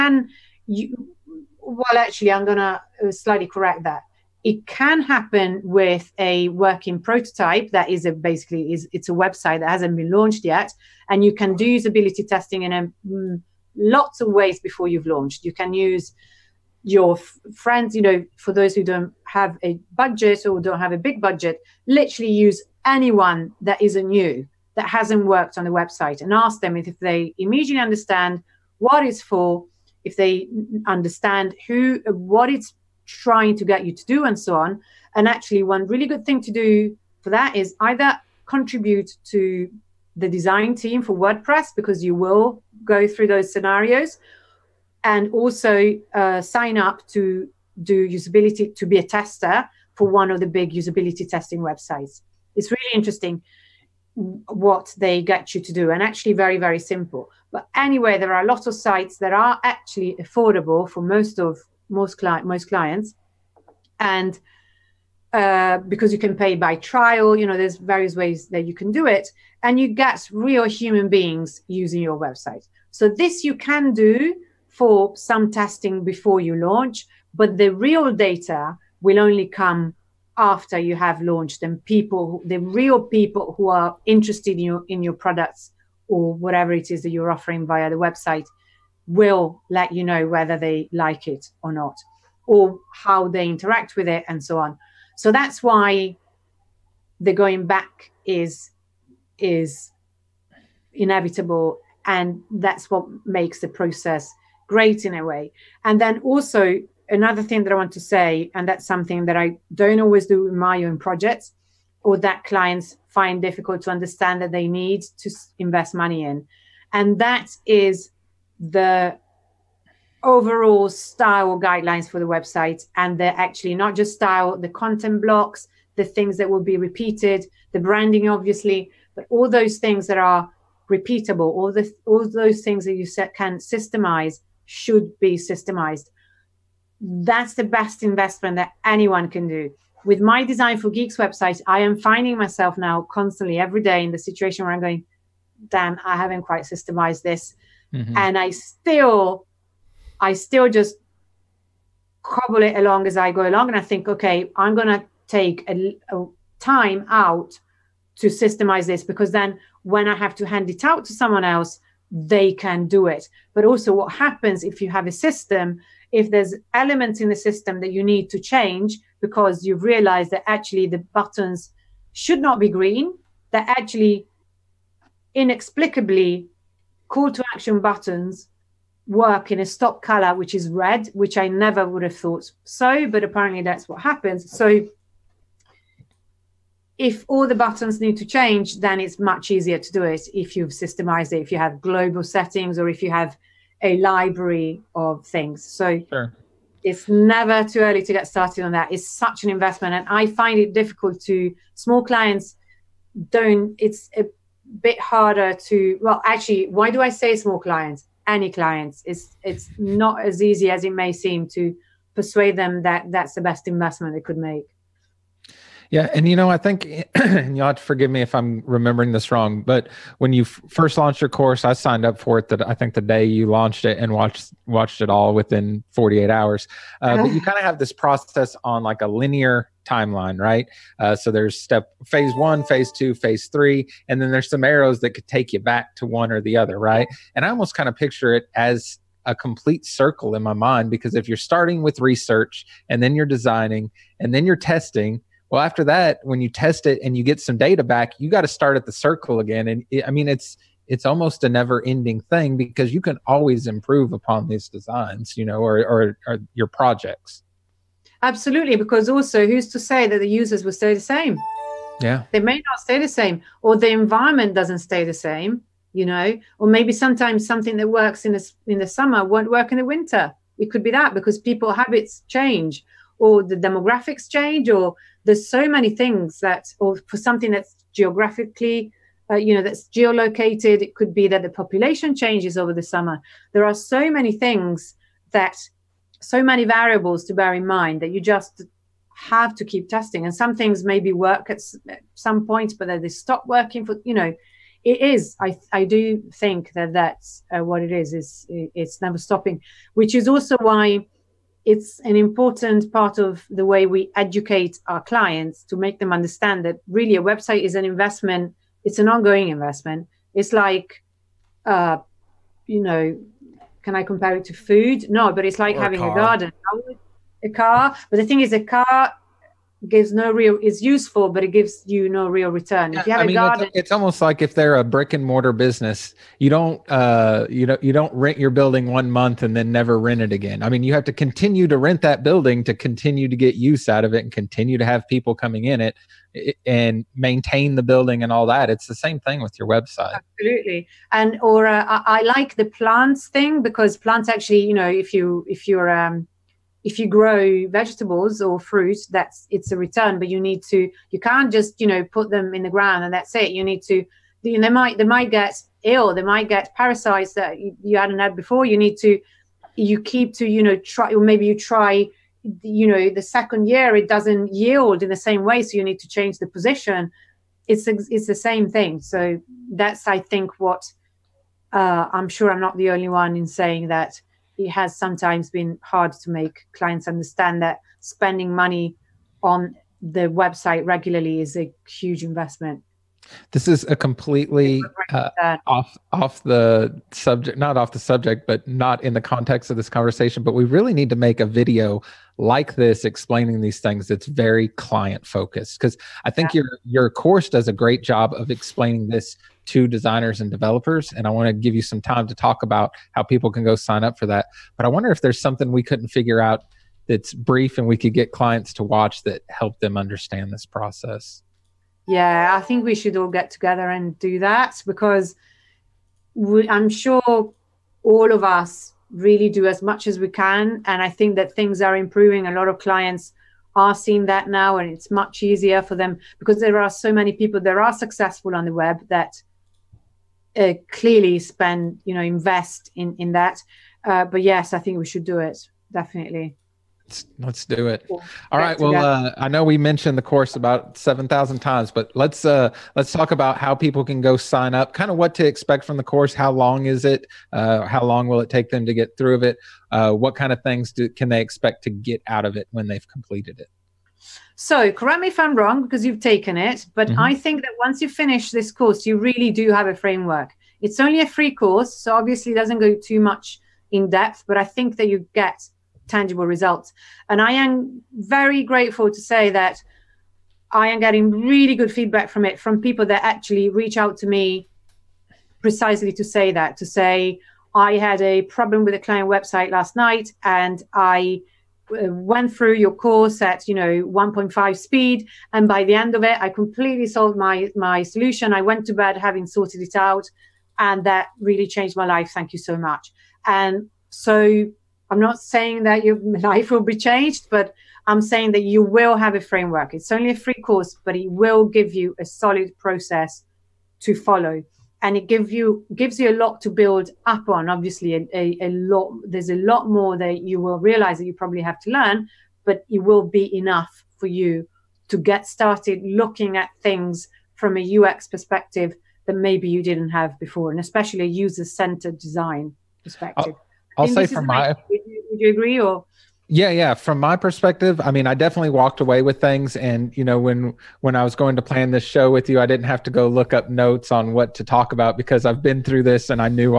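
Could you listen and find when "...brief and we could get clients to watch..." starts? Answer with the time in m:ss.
6:47.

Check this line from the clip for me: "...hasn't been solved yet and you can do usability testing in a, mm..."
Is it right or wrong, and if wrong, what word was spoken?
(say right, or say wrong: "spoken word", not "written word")
wrong: "launched", not "solved".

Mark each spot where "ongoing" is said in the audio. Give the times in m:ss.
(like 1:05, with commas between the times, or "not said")
5:09.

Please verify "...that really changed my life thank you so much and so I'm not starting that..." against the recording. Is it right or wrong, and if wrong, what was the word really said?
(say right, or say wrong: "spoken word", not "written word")
wrong: "saying", not "starting".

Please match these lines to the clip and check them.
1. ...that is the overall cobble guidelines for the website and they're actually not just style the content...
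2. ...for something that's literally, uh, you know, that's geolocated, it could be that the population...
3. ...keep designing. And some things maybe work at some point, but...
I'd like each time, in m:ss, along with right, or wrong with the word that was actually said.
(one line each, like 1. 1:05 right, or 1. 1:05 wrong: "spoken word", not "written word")
1. 1:57 wrong: "style", not "cobble"
2. 4:37 wrong: "geographically", not "literally"
3. 4:49 wrong: "testing", not "designing".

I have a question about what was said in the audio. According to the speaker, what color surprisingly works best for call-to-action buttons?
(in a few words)
Red.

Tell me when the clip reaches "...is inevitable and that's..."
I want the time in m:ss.
1:39.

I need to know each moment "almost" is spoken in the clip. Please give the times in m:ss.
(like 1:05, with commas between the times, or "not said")
3:57, 4:11, 5:23.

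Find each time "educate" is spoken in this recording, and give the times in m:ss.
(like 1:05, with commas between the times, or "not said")
5:04.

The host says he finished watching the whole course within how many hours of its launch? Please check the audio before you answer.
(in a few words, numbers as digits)
48.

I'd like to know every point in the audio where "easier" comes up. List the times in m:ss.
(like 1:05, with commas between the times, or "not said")
3:09, 7:05.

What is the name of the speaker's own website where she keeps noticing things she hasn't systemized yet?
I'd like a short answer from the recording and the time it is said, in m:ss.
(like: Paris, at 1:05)
Design for Geeks, at 2:20.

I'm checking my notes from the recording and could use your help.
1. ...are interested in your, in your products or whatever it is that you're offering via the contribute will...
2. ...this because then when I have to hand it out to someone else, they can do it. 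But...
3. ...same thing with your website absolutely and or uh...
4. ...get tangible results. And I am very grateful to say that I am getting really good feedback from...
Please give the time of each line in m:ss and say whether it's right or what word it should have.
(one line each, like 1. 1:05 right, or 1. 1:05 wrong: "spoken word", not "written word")
1. 1:23 wrong: "website", not "contribute"
2. 2:38 right
3. 5:38 right
4. 7:45 right.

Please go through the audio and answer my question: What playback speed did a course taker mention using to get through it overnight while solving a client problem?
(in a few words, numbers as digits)
1.5.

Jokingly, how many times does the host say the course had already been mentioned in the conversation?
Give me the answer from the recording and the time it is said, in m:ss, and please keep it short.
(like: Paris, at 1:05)
7000, at 7:20.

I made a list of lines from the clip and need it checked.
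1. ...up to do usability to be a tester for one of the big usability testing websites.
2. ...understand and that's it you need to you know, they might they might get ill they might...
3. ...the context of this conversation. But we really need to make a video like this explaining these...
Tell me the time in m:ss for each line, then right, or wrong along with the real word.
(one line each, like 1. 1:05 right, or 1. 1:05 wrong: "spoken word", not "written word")
1. 0:46 right
2. 5:52 wrong: "ground", not "understand"
3. 6:29 right.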